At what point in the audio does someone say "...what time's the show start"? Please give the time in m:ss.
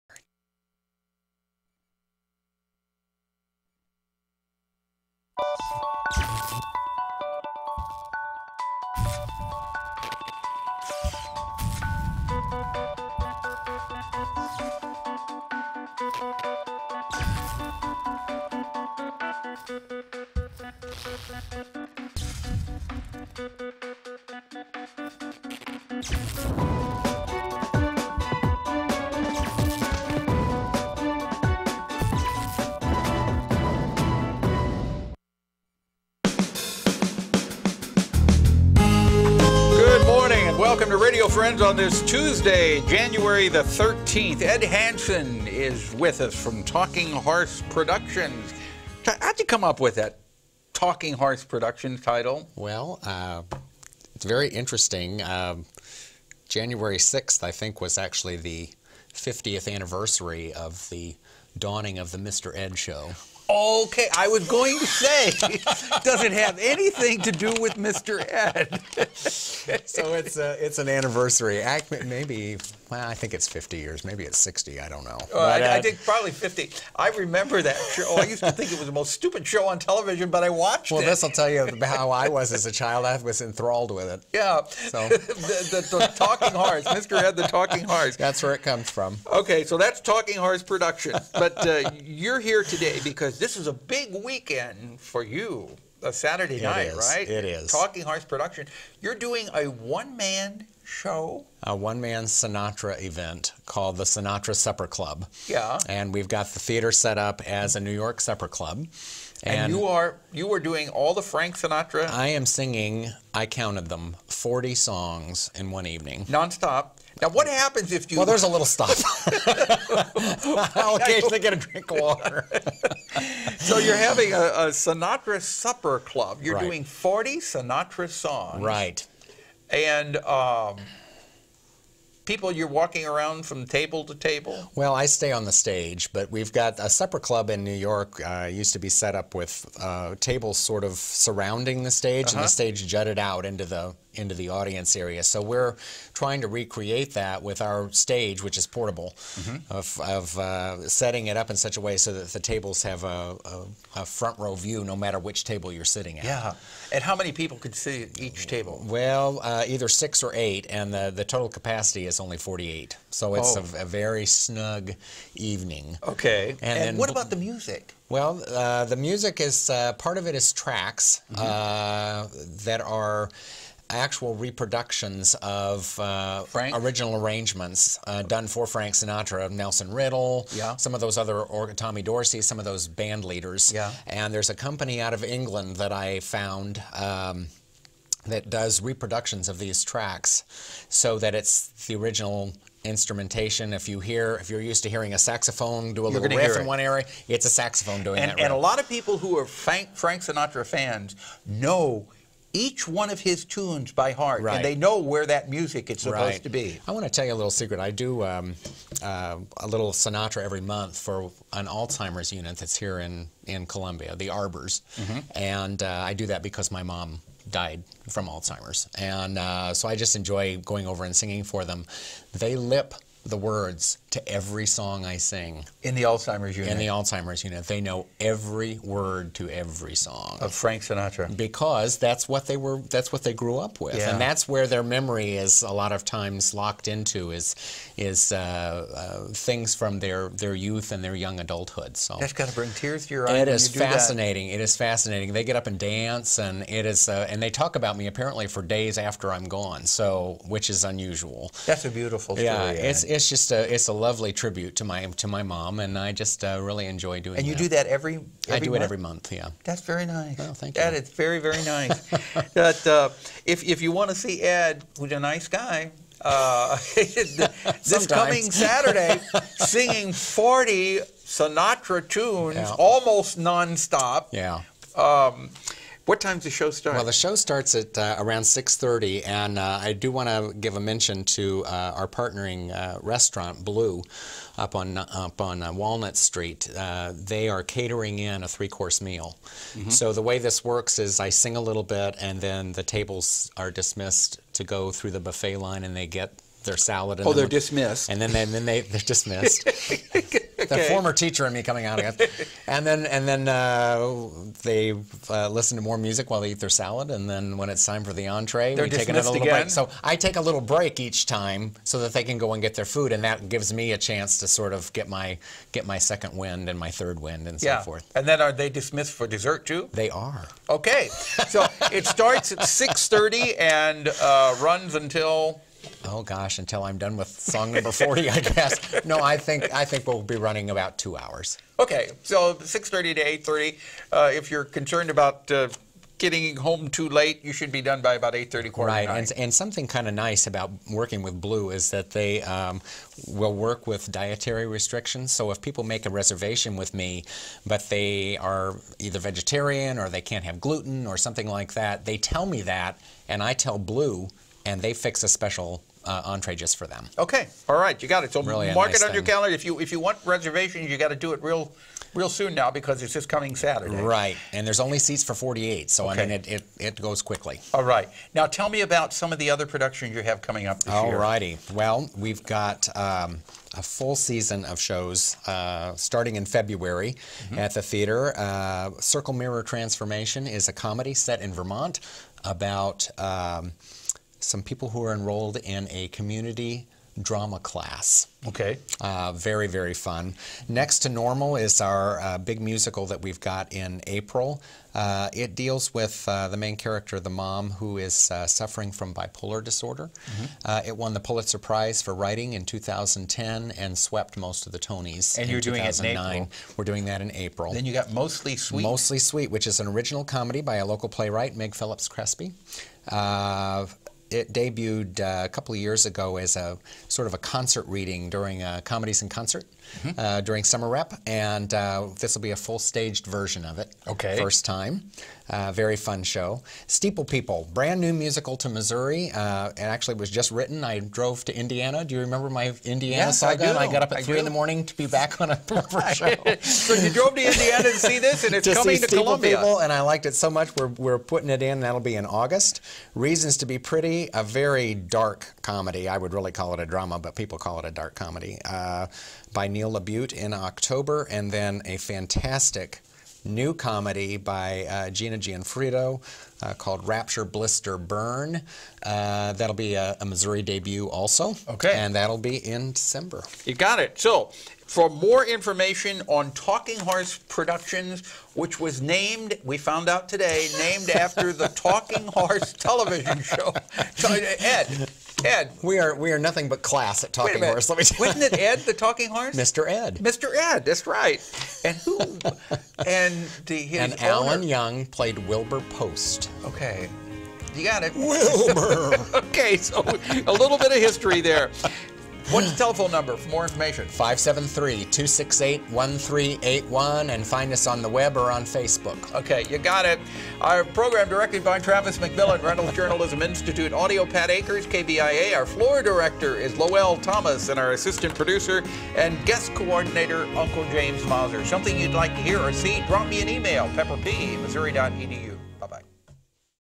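4:36.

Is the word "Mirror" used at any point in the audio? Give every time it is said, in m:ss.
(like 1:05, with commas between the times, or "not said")
6:19.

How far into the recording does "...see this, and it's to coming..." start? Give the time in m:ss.
7:18.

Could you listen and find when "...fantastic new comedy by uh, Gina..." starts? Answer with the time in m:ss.
7:31.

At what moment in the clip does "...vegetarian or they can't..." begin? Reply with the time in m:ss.
5:49.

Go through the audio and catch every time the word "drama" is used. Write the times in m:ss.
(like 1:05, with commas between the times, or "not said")
6:27, 7:26.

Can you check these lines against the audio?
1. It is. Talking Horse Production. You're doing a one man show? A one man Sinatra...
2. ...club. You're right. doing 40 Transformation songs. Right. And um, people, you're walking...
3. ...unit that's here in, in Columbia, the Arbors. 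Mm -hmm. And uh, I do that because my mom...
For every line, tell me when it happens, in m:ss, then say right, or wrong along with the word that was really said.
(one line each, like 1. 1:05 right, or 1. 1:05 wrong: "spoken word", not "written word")
1. 1:37 right
2. 2:05 wrong: "Sinatra", not "Transformation"
3. 3:32 right.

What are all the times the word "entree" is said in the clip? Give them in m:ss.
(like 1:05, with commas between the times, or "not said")
5:08, 5:56.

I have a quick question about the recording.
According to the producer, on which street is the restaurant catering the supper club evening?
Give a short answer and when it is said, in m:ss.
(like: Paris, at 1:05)
Walnut Street, at 4:45.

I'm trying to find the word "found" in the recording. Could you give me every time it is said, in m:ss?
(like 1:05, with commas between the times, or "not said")
3:06, 7:49.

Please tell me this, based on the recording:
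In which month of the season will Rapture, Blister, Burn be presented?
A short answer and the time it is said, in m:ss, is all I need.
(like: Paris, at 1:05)
December, at 7:42.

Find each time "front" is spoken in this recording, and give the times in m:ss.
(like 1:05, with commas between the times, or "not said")
2:34.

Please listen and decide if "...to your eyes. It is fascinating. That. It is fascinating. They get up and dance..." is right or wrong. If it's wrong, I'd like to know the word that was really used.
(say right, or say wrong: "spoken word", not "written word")
right.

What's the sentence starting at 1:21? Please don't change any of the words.
Well, this will tell you how I was as a child.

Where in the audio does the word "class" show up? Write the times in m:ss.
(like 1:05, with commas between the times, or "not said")
6:27, 7:56.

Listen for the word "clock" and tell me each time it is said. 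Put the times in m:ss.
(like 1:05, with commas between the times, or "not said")
not said.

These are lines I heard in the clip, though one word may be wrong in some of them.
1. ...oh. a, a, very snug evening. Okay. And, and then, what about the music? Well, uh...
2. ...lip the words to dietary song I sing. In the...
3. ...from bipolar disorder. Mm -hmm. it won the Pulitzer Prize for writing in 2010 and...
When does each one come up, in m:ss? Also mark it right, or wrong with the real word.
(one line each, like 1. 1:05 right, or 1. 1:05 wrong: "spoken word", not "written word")
1. 2:43 right
2. 3:42 wrong: "every", not "dietary"
3. 6:38 right.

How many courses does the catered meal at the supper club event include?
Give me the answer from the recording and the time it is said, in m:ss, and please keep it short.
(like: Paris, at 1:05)
3, at 4:48.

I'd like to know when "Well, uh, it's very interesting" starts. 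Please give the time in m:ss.
0:52.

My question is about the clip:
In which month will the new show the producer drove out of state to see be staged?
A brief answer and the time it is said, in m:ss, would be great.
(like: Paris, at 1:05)
August, at 7:22.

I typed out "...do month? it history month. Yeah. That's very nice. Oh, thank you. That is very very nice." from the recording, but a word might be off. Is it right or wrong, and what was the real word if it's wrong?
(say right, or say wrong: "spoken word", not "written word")
wrong: "every", not "history".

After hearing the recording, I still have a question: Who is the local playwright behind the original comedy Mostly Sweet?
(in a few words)
Meg Phillips Crespi.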